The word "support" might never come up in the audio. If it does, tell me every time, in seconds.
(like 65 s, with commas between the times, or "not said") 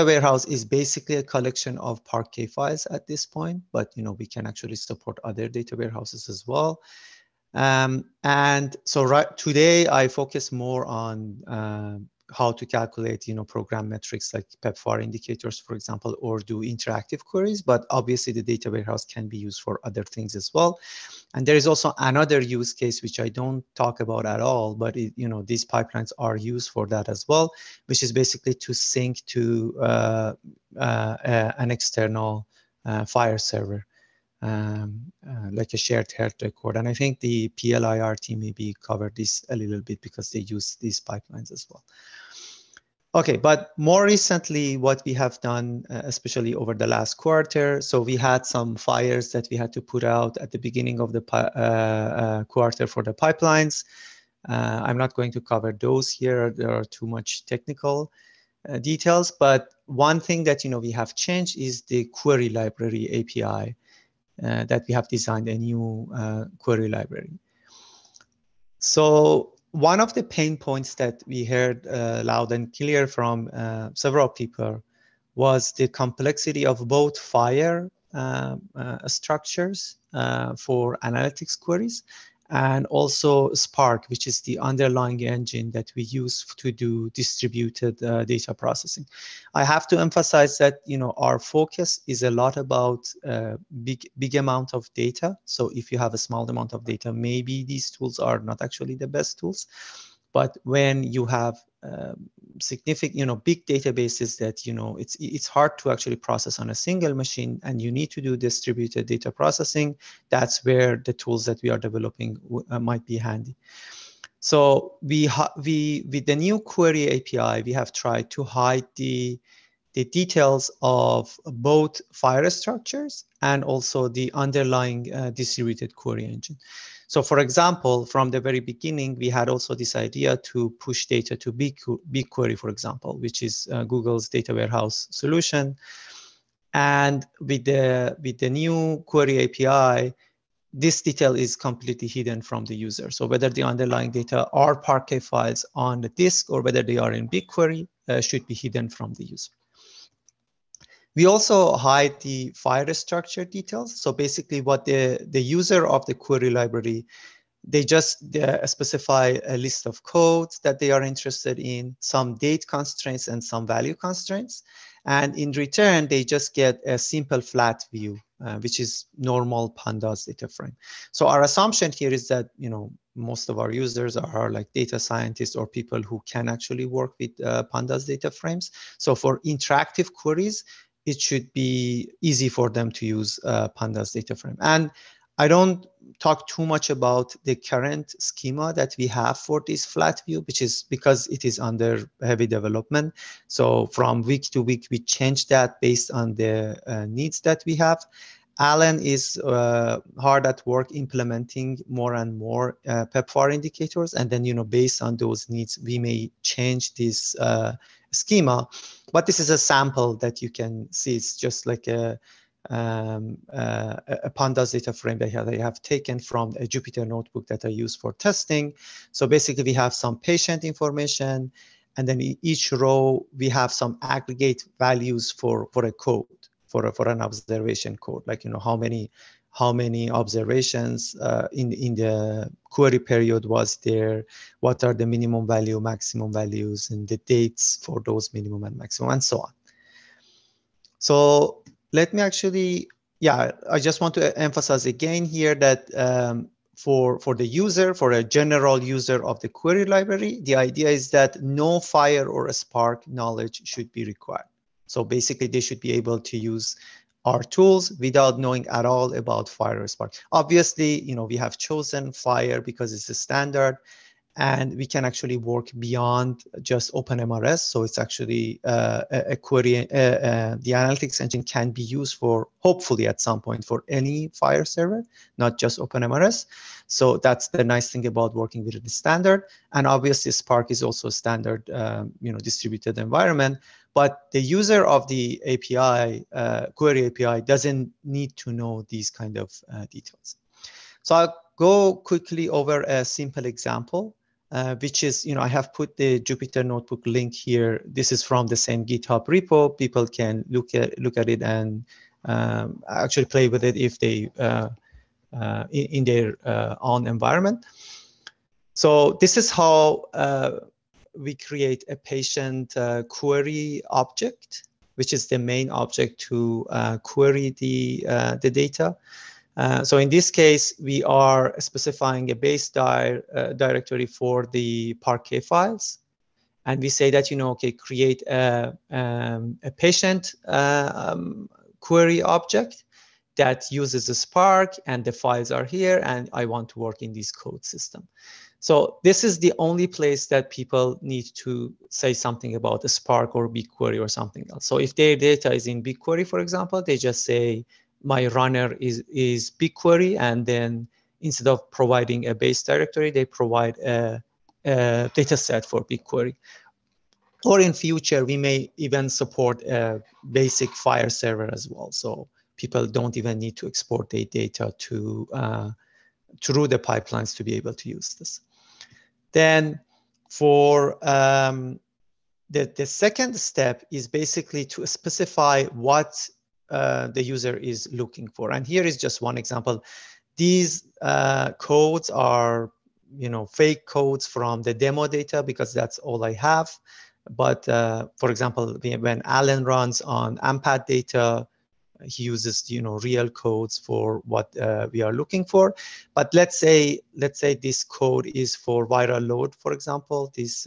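4 s, 359 s.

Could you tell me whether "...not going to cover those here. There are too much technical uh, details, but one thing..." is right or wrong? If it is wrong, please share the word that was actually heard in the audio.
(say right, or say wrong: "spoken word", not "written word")
right.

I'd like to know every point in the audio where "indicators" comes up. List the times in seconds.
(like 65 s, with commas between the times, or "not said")
15 s, 203 s.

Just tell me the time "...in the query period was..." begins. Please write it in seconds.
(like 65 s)
231 s.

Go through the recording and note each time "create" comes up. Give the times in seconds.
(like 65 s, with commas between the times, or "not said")
311 s, 327 s.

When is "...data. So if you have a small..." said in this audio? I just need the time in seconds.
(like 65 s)
94 s.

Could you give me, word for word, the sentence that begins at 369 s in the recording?
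Then for um, the, the second step is basically to specify what uh, the user is looking for.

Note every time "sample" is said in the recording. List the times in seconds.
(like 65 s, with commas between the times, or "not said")
209 s.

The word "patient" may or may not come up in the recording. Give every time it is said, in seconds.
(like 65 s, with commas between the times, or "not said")
220 s, 311 s, 329 s.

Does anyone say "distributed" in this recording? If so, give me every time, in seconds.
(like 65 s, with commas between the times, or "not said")
87 s, 108 s, 125 s, 282 s.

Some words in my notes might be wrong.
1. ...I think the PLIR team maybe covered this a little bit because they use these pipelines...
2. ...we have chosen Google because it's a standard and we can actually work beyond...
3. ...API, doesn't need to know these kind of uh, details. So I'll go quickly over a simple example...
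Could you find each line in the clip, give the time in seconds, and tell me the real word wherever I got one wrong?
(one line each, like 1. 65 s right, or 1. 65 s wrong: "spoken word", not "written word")
1. 36 s right
2. 261 s wrong: "FHIR", not "Google"
3. 287 s right.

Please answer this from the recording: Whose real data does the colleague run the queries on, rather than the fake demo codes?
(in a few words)
AMPATH.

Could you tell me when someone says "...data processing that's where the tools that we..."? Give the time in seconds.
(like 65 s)
109 s.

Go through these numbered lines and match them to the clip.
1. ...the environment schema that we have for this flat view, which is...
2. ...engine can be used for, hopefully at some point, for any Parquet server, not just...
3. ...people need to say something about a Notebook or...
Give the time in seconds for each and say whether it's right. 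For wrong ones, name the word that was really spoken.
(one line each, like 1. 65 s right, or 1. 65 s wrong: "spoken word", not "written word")
1. 187 s wrong: "current", not "environment"
2. 271 s wrong: "FHIR", not "Parquet"
3. 340 s wrong: "Spark", not "Notebook".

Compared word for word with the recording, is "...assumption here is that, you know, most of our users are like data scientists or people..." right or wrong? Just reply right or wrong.
right.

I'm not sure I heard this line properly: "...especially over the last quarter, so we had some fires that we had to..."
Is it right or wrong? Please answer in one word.
right.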